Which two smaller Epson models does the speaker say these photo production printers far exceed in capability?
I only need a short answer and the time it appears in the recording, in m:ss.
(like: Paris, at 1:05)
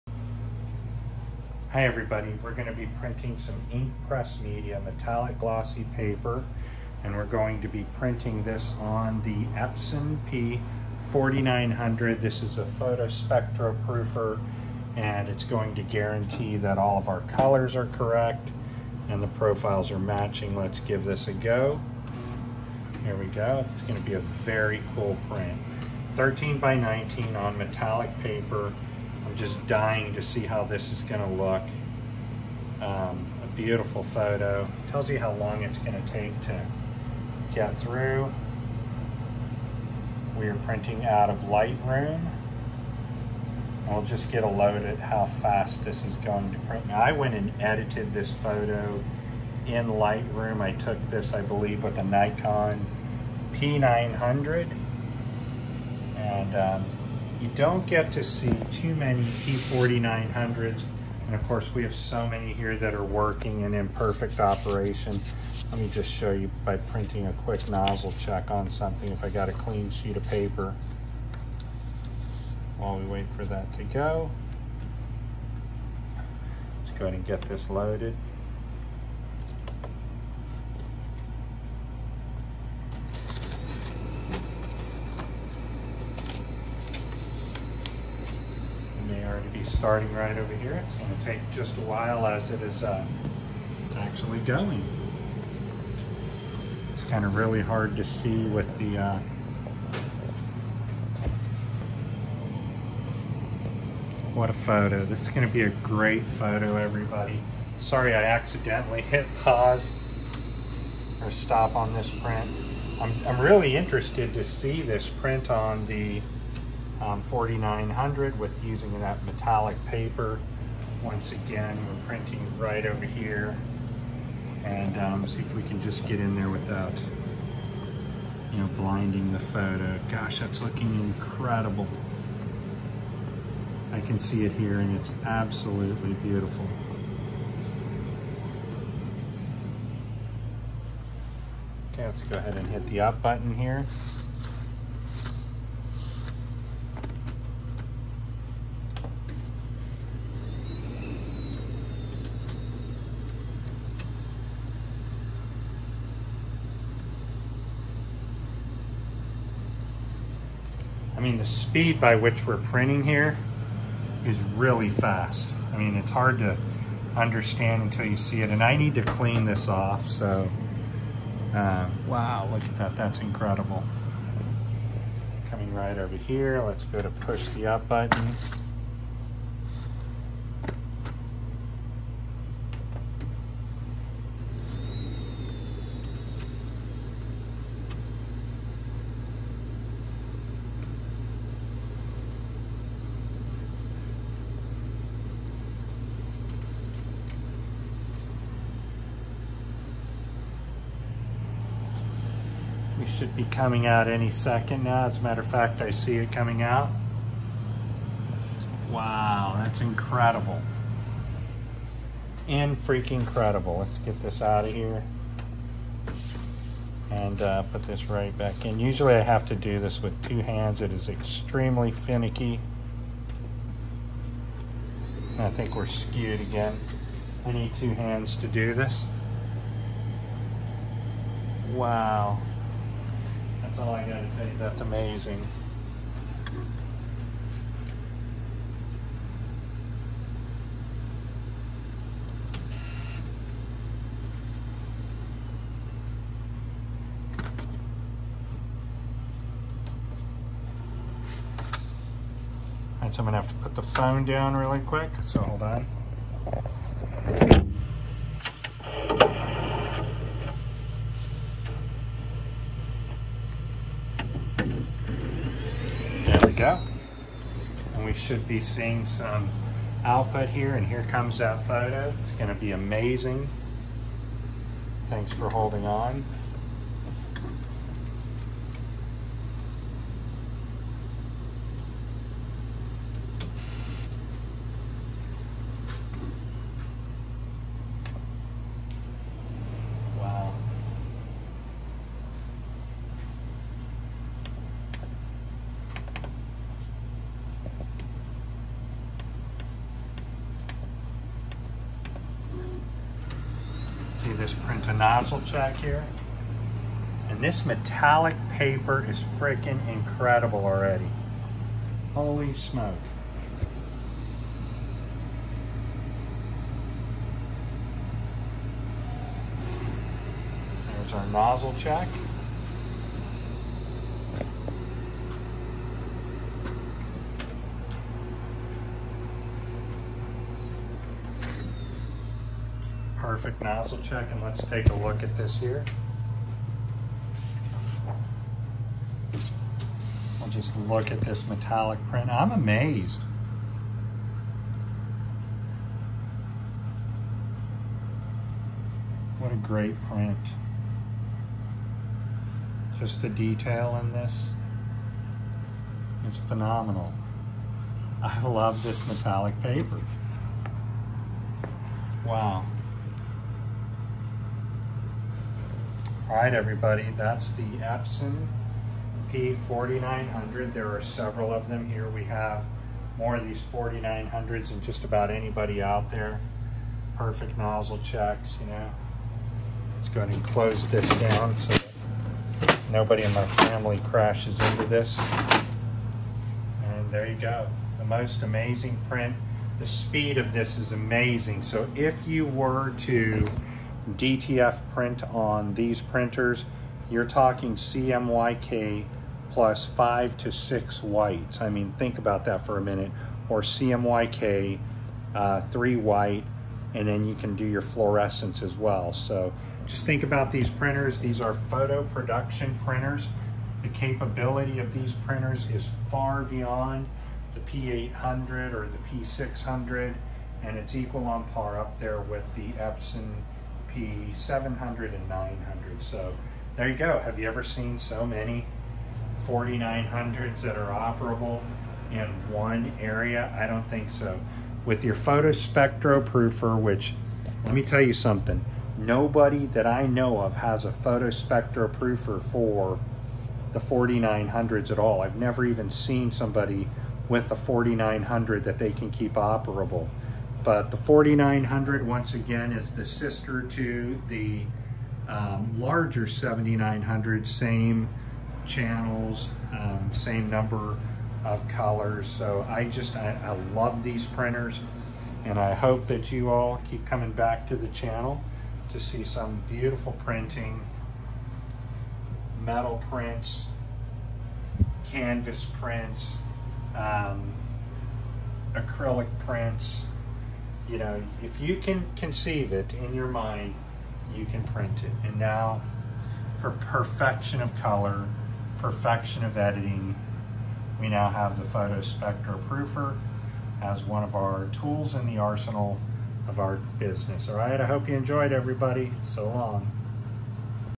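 P800 and P600, at 6:57.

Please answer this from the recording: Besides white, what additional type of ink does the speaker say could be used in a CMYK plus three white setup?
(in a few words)
fluorescence.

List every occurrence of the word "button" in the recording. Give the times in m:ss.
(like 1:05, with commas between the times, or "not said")
2:23, 2:57.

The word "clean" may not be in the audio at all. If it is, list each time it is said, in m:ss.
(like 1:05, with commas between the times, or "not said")
1:09, 2:49.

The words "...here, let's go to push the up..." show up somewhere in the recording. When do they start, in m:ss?
2:56.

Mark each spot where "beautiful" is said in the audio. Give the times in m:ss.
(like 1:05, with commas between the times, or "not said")
0:33, 2:16, 7:49.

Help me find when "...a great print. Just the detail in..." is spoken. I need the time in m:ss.
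5:49.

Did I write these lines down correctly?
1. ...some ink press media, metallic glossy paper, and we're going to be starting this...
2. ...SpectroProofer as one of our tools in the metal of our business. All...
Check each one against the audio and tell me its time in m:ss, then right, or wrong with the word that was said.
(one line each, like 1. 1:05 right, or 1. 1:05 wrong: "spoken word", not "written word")
1. 0:03 wrong: "printing", not "starting"
2. 8:12 wrong: "arsenal", not "metal".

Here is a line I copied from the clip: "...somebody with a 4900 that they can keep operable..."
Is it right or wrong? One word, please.
right.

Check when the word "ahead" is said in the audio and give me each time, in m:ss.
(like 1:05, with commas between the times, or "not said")
1:17, 2:22, 6:20.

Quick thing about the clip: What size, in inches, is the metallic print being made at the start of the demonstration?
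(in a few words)
13 by 19.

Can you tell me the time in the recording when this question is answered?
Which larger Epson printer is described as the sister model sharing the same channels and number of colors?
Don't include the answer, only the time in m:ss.
7:36.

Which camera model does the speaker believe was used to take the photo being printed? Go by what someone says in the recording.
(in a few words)
Nikon P900.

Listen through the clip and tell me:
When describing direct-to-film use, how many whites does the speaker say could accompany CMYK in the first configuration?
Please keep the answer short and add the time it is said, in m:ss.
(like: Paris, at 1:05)
5 to 6, at 6:39.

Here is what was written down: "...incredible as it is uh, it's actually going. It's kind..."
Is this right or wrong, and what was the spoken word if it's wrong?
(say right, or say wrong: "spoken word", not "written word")
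wrong: "while", not "incredible".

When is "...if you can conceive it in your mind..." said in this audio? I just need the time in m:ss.
8:01.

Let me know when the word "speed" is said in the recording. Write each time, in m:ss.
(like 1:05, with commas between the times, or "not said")
2:41, 6:29.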